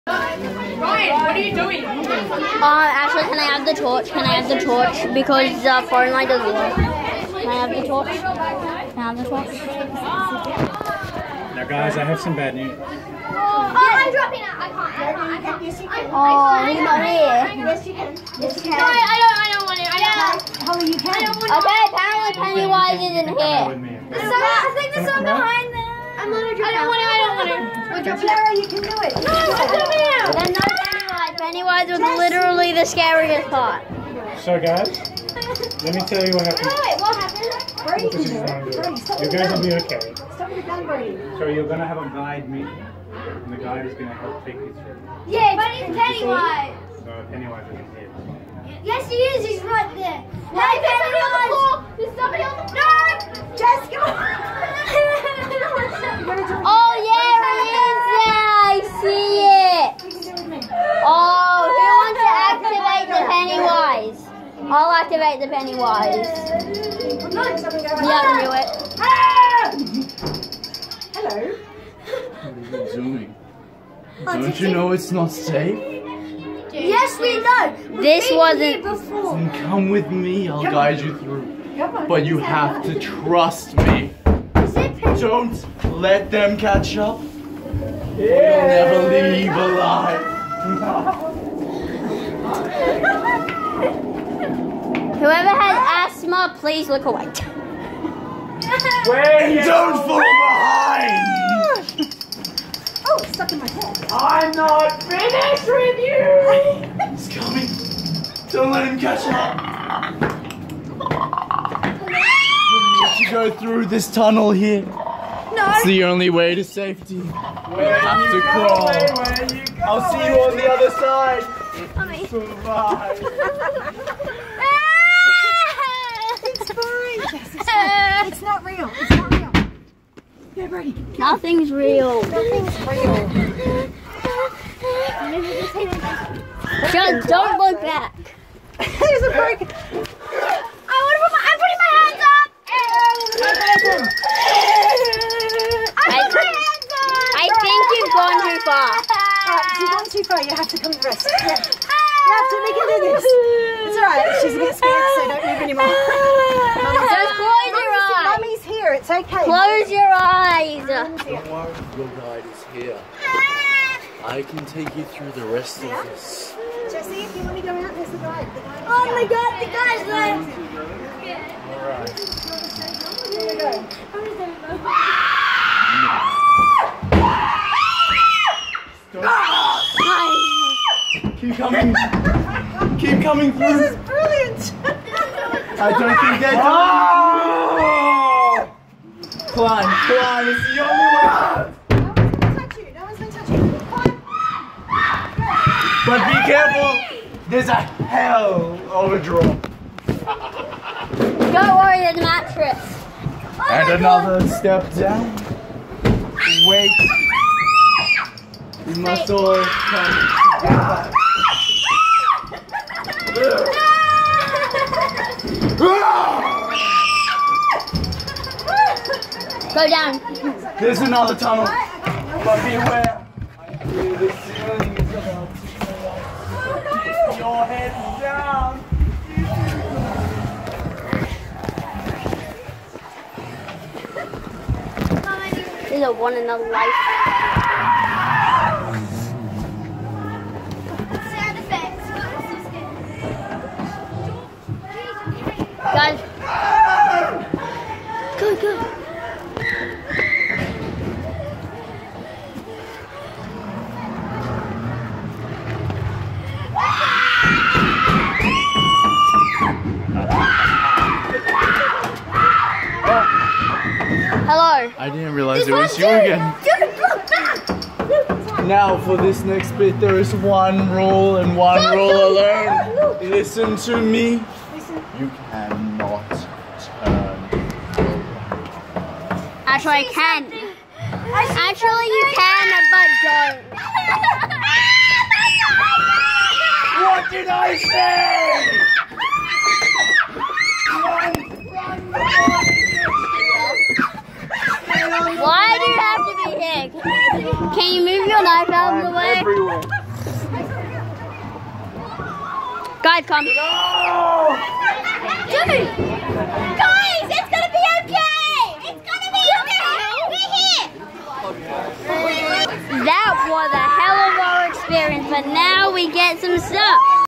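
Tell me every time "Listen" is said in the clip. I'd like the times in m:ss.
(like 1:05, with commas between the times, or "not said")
4:33.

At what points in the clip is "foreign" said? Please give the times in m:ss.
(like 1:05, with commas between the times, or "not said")
0:05.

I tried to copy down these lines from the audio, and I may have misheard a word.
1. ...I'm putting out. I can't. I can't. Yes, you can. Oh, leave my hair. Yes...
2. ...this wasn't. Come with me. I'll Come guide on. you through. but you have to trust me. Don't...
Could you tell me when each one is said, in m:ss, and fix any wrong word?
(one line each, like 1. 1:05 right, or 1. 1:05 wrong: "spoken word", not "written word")
1. 0:13 wrong: "dropping", not "putting"
2. 1:18 right.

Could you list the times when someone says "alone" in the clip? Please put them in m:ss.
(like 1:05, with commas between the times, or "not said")
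4:32.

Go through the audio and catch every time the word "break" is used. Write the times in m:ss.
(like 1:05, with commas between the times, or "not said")
2:19.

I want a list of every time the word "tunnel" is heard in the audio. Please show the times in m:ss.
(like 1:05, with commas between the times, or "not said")
1:54, 3:41.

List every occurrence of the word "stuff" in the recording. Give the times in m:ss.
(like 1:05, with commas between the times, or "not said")
5:16.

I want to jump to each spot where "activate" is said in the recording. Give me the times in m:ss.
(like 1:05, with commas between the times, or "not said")
1:04.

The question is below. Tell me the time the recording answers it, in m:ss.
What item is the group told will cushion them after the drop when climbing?
3:22.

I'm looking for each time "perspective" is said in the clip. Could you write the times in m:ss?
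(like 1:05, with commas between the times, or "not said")
not said.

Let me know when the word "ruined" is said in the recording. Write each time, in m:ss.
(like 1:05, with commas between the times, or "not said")
not said.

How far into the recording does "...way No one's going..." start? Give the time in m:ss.
3:10.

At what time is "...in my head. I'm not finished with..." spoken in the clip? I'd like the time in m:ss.
1:43.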